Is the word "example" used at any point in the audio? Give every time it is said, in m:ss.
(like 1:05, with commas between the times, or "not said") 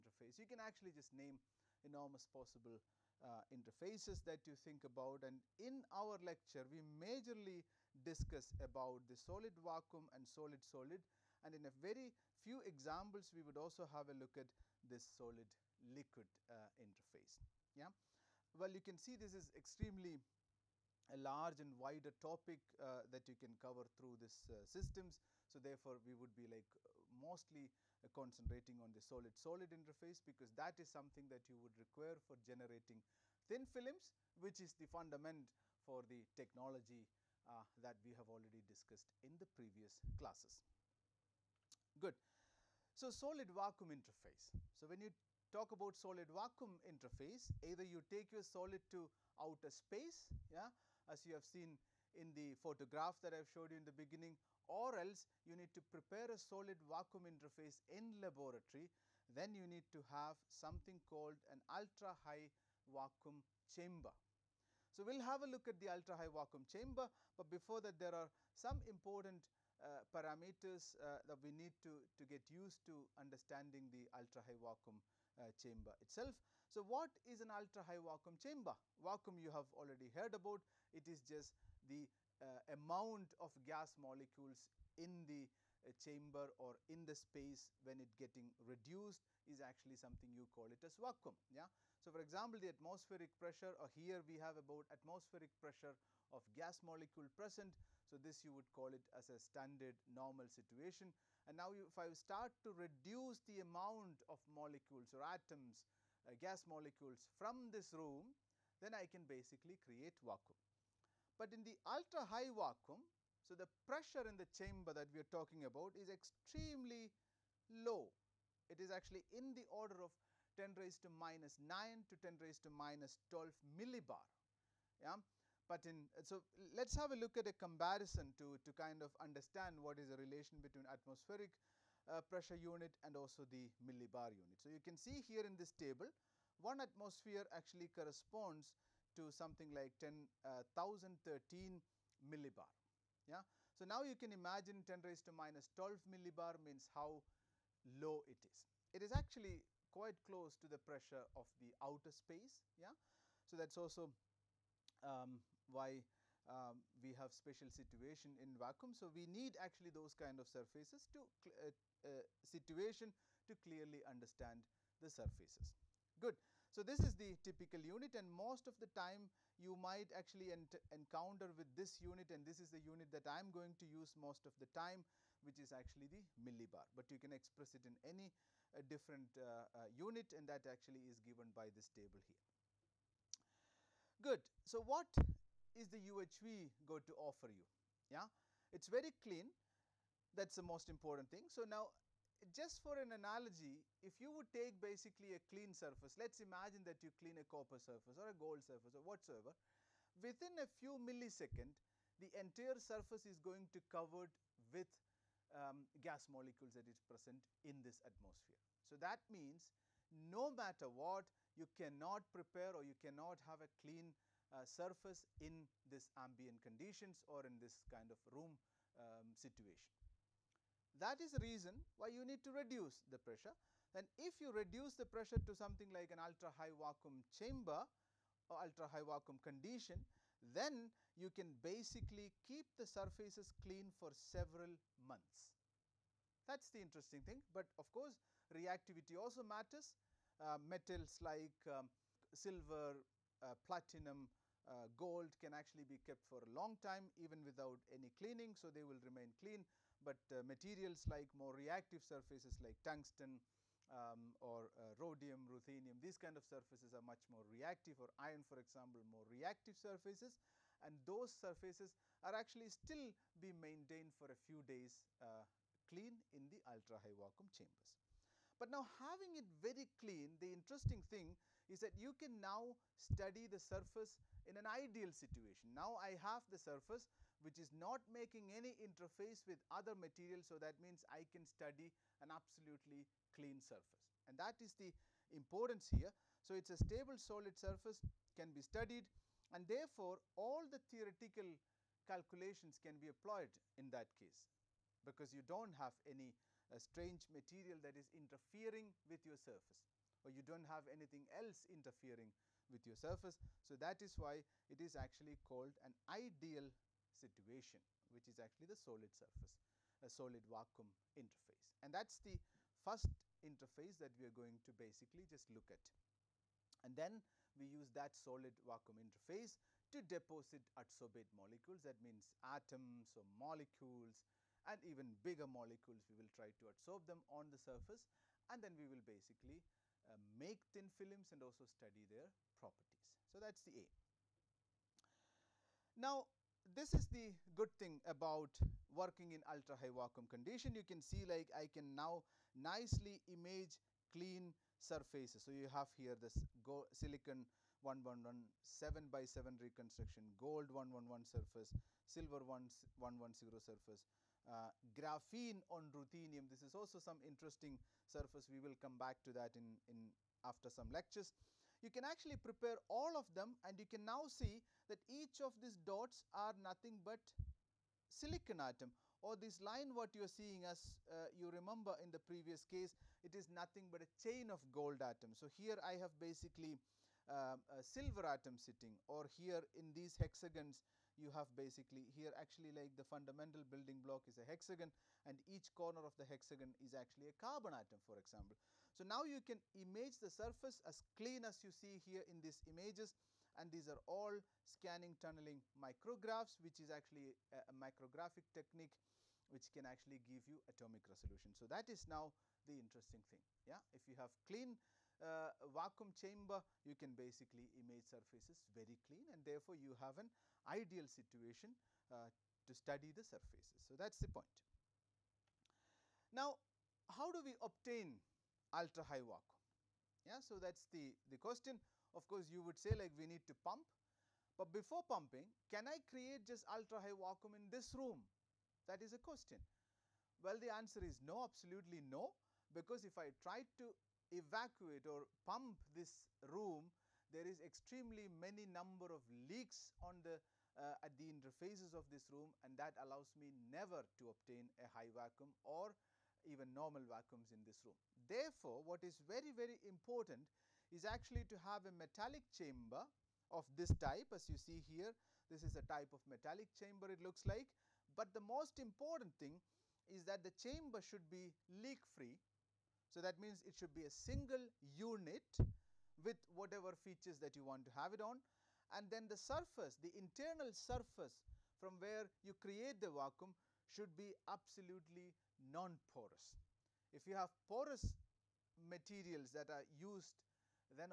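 0:12, 1:32, 4:18, 6:28.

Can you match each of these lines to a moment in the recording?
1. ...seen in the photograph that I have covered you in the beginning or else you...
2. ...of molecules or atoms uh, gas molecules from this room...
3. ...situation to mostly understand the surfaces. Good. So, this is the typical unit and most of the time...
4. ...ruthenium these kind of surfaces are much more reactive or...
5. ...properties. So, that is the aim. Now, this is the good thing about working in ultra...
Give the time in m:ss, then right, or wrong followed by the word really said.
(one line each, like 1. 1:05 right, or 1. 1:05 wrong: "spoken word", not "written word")
1. 0:51 wrong: "showed", not "covered"
2. 1:44 right
3. 2:42 wrong: "clearly", not "mostly"
4. 4:15 right
5. 5:32 right.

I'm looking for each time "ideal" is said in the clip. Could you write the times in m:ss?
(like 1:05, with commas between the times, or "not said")
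4:34, 5:06, 6:50.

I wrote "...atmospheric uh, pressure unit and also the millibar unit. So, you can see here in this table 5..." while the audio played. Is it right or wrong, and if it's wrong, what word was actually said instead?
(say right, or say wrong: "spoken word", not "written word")
wrong: "1", not "5".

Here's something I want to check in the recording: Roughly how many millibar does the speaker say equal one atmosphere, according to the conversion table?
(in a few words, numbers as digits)
10,013.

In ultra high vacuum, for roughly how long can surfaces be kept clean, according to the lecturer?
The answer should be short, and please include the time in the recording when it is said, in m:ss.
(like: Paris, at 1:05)
several months, at 3:54.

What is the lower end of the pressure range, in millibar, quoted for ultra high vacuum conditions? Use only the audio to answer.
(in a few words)
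10^-9 millibar.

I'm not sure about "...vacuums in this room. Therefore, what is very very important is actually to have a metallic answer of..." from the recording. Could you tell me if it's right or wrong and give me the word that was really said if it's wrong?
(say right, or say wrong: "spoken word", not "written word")
wrong: "chamber", not "answer".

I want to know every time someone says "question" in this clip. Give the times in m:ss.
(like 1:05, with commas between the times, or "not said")
7:01, 7:09.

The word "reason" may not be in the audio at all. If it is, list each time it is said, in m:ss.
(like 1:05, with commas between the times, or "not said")
3:41.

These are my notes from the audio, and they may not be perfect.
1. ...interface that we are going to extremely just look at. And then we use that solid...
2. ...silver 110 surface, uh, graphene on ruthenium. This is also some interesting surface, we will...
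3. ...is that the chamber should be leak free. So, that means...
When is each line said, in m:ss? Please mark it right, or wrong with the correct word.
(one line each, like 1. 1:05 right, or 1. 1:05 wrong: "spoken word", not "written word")
1. 5:13 wrong: "basically", not "extremely"
2. 5:52 right
3. 7:40 right.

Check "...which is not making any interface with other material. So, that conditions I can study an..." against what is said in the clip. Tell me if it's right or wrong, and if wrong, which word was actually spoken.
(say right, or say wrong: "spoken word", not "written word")
wrong: "means", not "conditions".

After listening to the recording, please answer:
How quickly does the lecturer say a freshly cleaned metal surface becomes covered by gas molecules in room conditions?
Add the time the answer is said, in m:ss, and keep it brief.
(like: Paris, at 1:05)
a few milliseconds, at 3:20.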